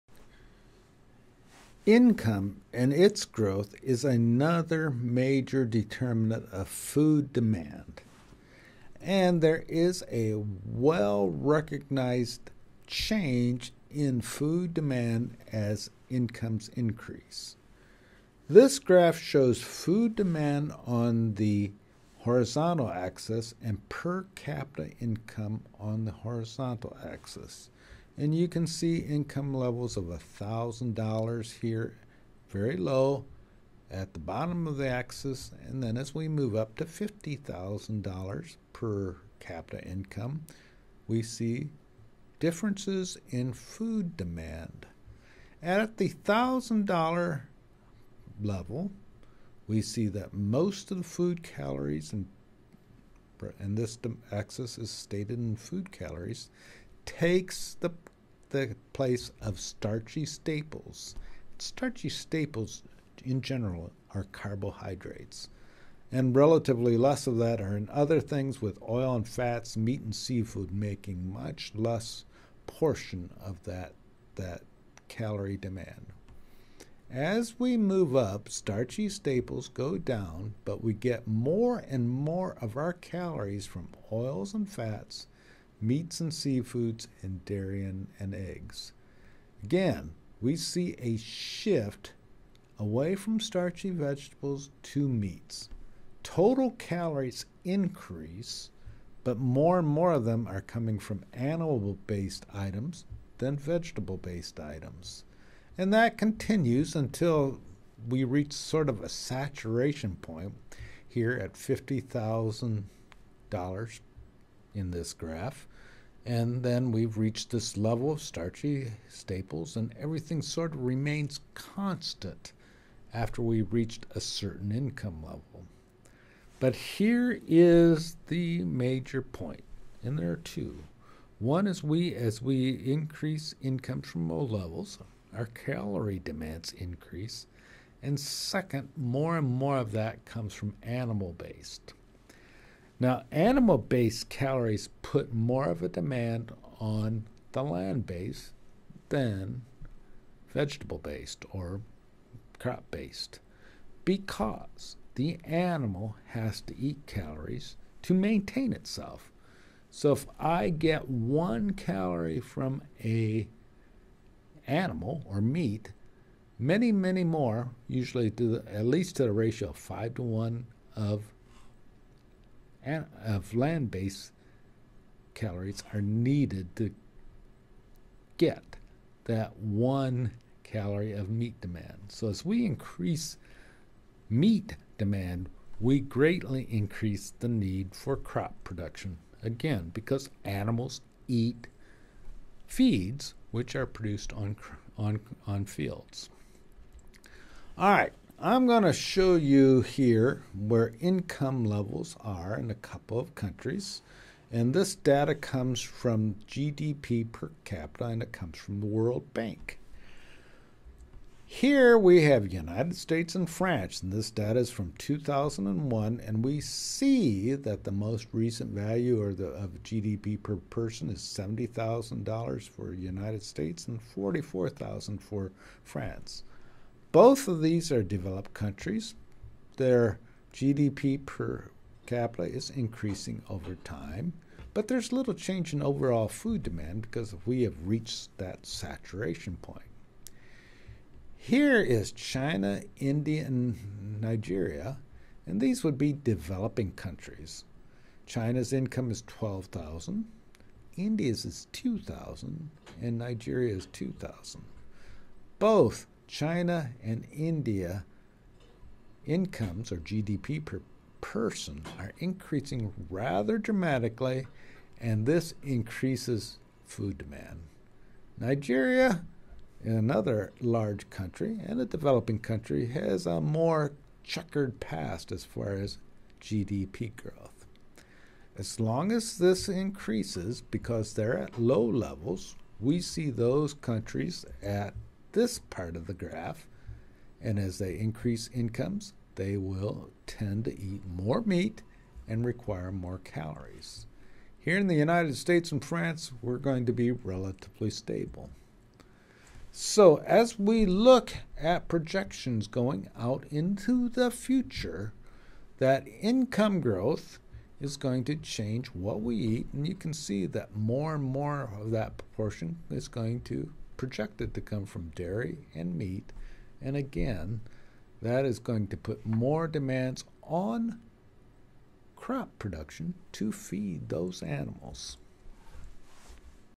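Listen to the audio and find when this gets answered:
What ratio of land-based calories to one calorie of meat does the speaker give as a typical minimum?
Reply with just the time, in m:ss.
2:49.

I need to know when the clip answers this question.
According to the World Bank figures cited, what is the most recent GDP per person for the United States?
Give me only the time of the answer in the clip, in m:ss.
3:41.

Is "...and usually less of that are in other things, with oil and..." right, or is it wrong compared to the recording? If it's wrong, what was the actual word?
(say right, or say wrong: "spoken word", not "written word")
wrong: "relatively", not "usually".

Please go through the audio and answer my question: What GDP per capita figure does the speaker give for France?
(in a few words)
44,000.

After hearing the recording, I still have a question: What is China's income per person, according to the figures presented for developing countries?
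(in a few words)
12,000.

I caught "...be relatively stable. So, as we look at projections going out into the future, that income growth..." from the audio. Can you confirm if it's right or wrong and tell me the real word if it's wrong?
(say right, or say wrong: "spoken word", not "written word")
right.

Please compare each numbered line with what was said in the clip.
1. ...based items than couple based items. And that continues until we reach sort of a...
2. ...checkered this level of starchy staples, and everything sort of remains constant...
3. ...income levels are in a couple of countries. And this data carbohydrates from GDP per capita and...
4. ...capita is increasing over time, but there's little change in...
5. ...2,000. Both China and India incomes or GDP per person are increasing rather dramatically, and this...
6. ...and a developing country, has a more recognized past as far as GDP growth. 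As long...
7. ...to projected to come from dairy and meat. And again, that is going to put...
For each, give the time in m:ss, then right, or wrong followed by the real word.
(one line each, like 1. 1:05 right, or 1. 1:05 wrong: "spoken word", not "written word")
1. 1:42 wrong: "vegetable", not "couple"
2. 1:57 wrong: "reached", not "checkered"
3. 3:20 wrong: "comes", not "carbohydrates"
4. 3:52 right
5. 4:13 right
6. 4:31 wrong: "checkered", not "recognized"
7. 5:13 right.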